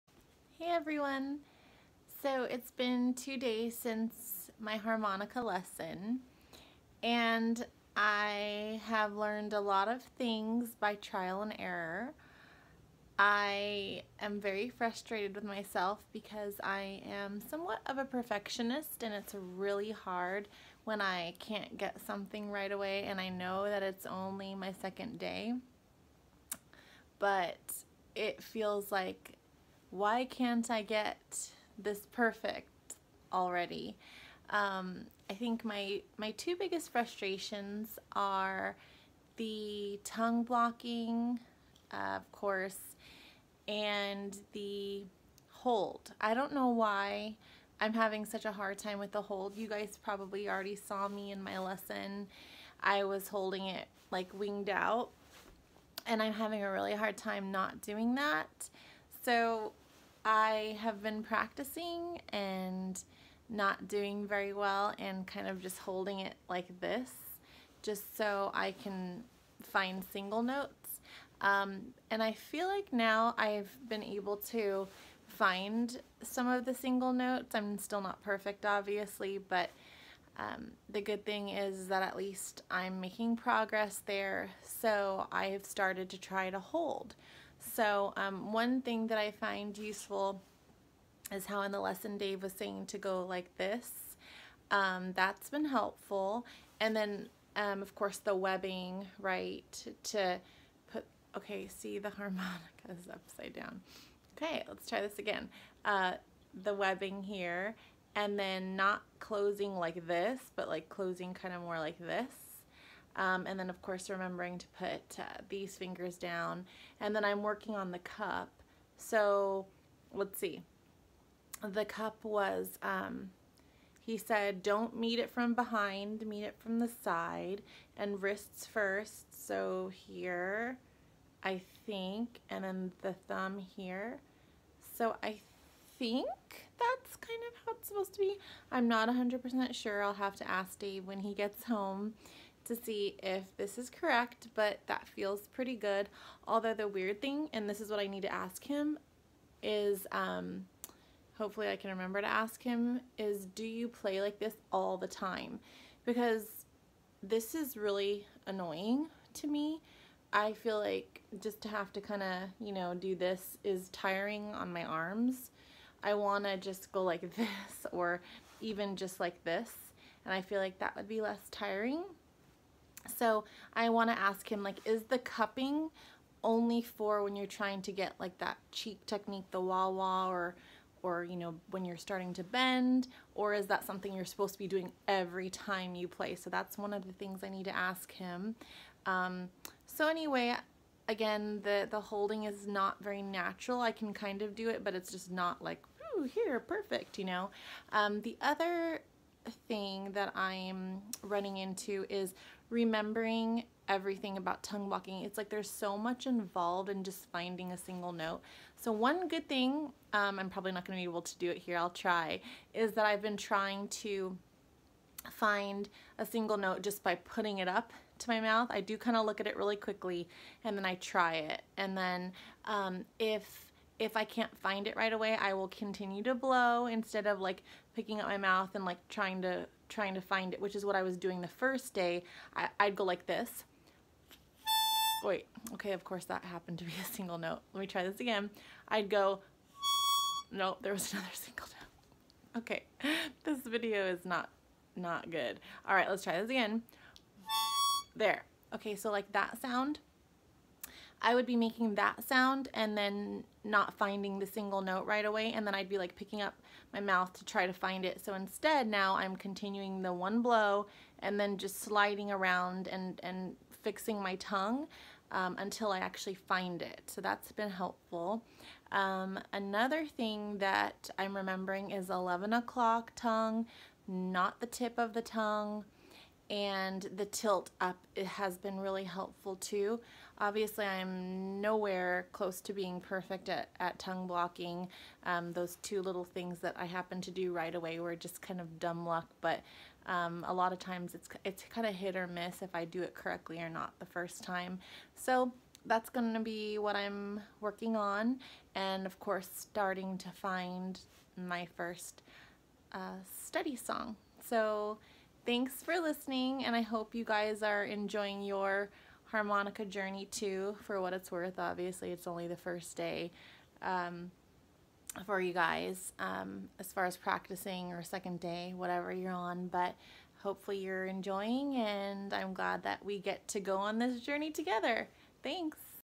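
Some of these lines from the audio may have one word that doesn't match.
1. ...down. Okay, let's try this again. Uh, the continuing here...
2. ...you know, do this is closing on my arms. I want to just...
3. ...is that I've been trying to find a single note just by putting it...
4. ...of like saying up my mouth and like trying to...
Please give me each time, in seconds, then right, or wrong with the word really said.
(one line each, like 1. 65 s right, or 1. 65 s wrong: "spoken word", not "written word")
1. 103 s wrong: "webbing", not "continuing"
2. 162 s wrong: "tiring", not "closing"
3. 212 s right
4. 227 s wrong: "picking", not "saying".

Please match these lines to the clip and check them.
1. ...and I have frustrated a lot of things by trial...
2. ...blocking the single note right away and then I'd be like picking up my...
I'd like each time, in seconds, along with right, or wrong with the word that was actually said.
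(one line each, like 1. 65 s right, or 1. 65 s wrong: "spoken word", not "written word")
1. 7 s wrong: "learned", not "frustrated"
2. 253 s wrong: "finding", not "blocking".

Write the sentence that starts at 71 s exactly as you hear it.
Um, and I feel like now I've been able to find some of the single notes.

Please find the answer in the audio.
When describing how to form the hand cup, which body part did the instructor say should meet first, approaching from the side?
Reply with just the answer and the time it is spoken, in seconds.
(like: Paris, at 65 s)
Wrists, at 128 s.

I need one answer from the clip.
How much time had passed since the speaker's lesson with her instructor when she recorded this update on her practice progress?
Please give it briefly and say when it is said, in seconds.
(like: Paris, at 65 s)
2 days, at 3 s.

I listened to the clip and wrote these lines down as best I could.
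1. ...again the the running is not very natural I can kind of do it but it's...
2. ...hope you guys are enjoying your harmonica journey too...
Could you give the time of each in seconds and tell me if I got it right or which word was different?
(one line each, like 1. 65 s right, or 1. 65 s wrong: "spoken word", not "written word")
1. 191 s wrong: "holding", not "running"
2. 306 s right.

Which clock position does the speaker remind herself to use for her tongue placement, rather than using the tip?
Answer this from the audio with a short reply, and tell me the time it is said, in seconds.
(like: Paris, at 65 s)
11 o'clock, at 272 s.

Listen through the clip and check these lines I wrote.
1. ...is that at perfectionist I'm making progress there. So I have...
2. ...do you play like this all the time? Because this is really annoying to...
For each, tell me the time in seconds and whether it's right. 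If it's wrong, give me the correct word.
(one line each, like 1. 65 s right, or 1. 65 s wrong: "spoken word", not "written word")
1. 81 s wrong: "least", not "perfectionist"
2. 153 s right.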